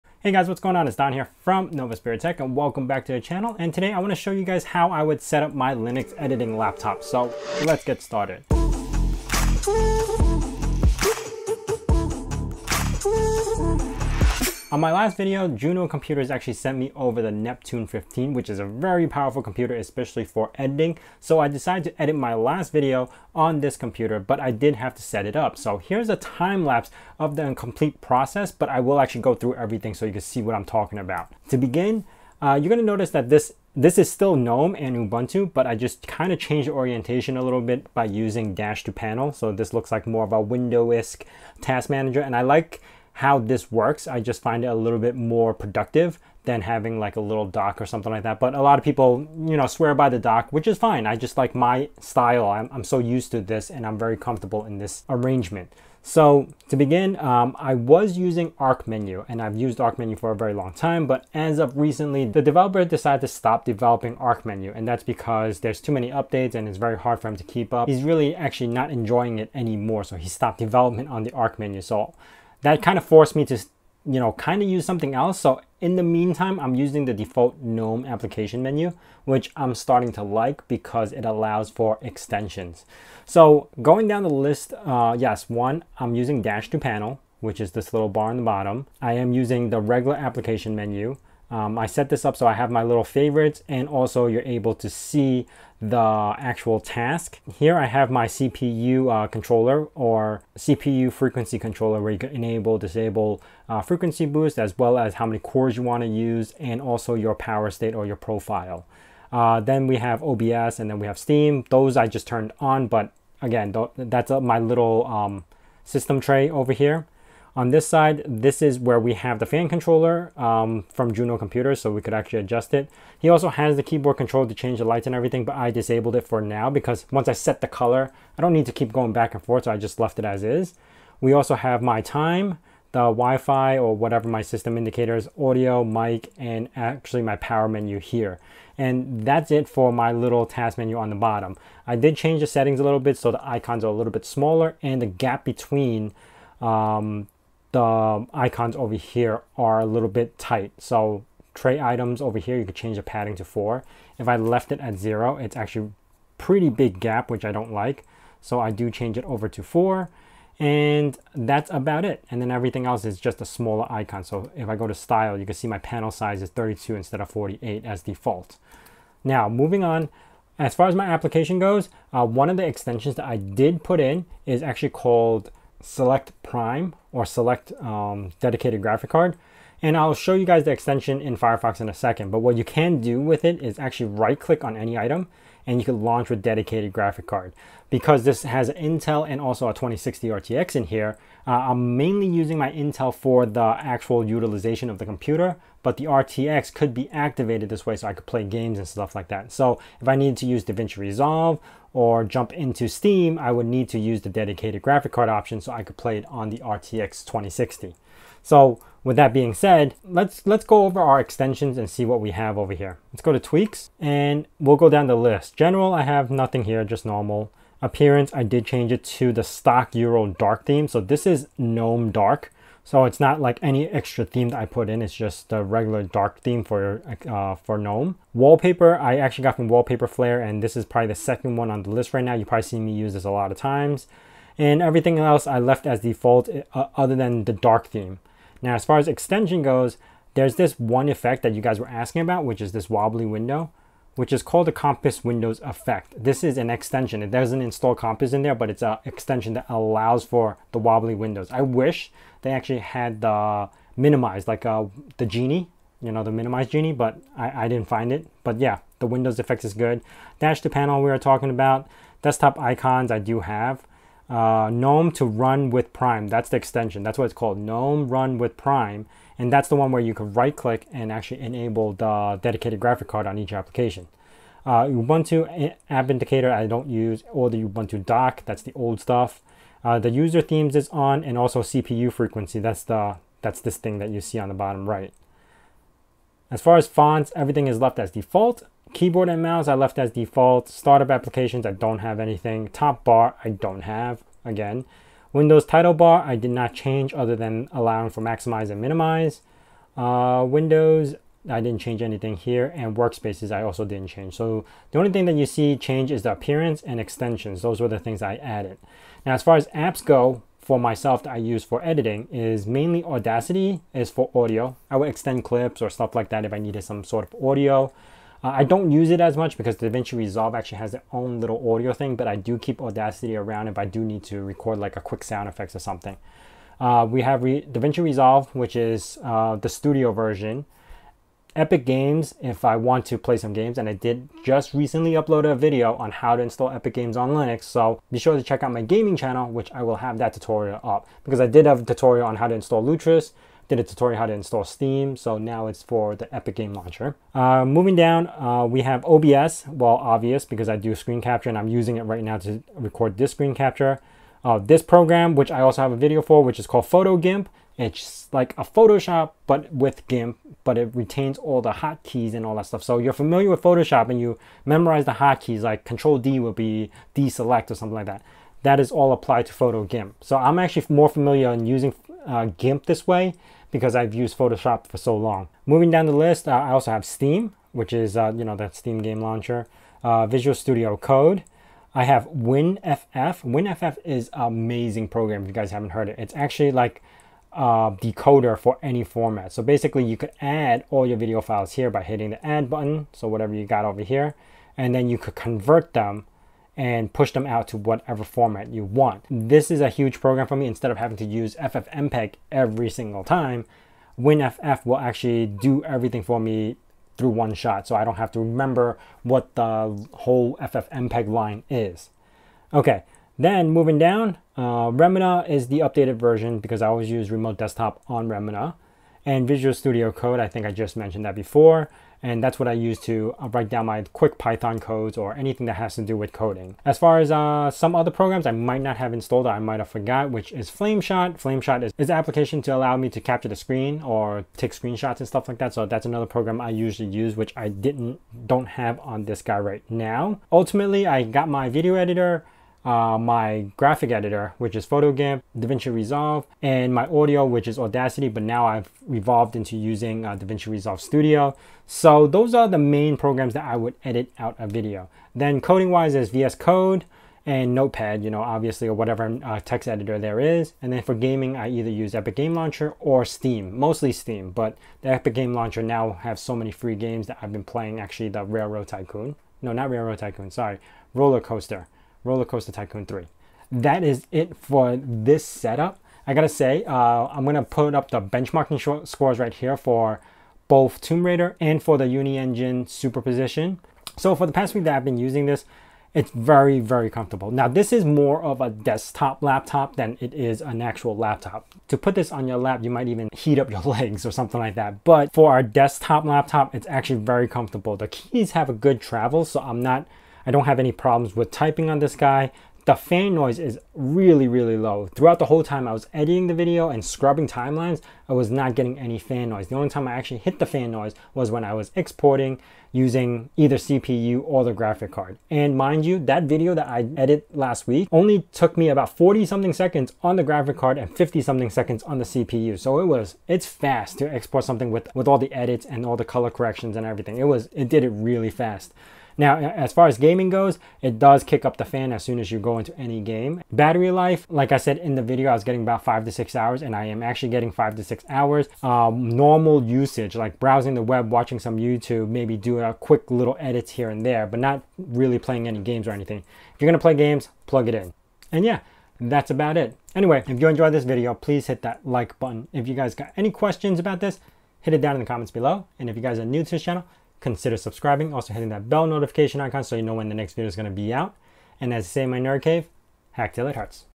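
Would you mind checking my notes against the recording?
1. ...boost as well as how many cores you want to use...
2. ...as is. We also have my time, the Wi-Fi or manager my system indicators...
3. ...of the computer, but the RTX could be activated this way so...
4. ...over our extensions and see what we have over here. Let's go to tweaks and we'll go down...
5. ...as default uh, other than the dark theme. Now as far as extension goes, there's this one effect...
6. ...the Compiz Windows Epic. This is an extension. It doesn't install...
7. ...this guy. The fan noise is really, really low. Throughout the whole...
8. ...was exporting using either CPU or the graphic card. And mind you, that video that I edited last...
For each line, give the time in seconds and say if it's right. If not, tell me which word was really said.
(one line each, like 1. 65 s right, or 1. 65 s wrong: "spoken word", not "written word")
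1. 104 s right
2. 130 s wrong: "whatever", not "manager"
3. 194 s right
4. 210 s right
5. 235 s right
6. 244 s wrong: "Effect", not "Epic"
7. 501 s right
8. 511 s right.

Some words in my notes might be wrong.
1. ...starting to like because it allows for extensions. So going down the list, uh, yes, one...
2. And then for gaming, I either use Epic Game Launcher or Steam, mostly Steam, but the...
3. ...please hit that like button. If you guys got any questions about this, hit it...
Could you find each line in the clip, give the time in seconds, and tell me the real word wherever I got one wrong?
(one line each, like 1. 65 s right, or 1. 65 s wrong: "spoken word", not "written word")
1. 79 s right
2. 460 s right
3. 551 s right.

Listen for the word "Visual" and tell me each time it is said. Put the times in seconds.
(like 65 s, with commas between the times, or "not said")
380 s, 419 s.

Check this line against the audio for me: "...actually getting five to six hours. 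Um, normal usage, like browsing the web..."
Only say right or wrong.
right.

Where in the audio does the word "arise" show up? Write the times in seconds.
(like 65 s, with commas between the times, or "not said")
not said.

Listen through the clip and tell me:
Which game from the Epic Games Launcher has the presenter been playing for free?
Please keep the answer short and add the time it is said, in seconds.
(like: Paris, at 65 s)
Roller Coaster Tycoon 3, at 472 s.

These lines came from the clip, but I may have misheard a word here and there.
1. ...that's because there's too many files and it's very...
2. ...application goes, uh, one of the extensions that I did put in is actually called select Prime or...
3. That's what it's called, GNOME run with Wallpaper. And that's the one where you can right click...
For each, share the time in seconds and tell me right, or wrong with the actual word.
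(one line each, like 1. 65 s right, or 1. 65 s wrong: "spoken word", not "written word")
1. 64 s wrong: "updates", not "files"
2. 171 s right
3. 267 s wrong: "Prime", not "Wallpaper".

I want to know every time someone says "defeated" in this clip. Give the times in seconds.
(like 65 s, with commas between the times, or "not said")
not said.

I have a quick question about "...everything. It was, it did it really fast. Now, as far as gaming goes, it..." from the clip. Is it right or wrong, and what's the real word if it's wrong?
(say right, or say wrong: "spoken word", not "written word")
right.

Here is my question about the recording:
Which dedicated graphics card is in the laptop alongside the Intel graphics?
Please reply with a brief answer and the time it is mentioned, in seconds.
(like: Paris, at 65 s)
RTX 2060, at 189 s.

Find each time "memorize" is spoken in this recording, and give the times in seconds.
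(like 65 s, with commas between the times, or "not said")
364 s.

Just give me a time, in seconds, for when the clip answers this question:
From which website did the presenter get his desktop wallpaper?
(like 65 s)
229 s.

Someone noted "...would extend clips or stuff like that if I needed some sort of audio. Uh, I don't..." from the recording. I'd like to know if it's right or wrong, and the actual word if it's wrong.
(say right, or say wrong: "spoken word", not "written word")
right.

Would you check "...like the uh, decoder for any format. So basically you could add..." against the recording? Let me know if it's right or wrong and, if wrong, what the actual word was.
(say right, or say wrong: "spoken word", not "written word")
right.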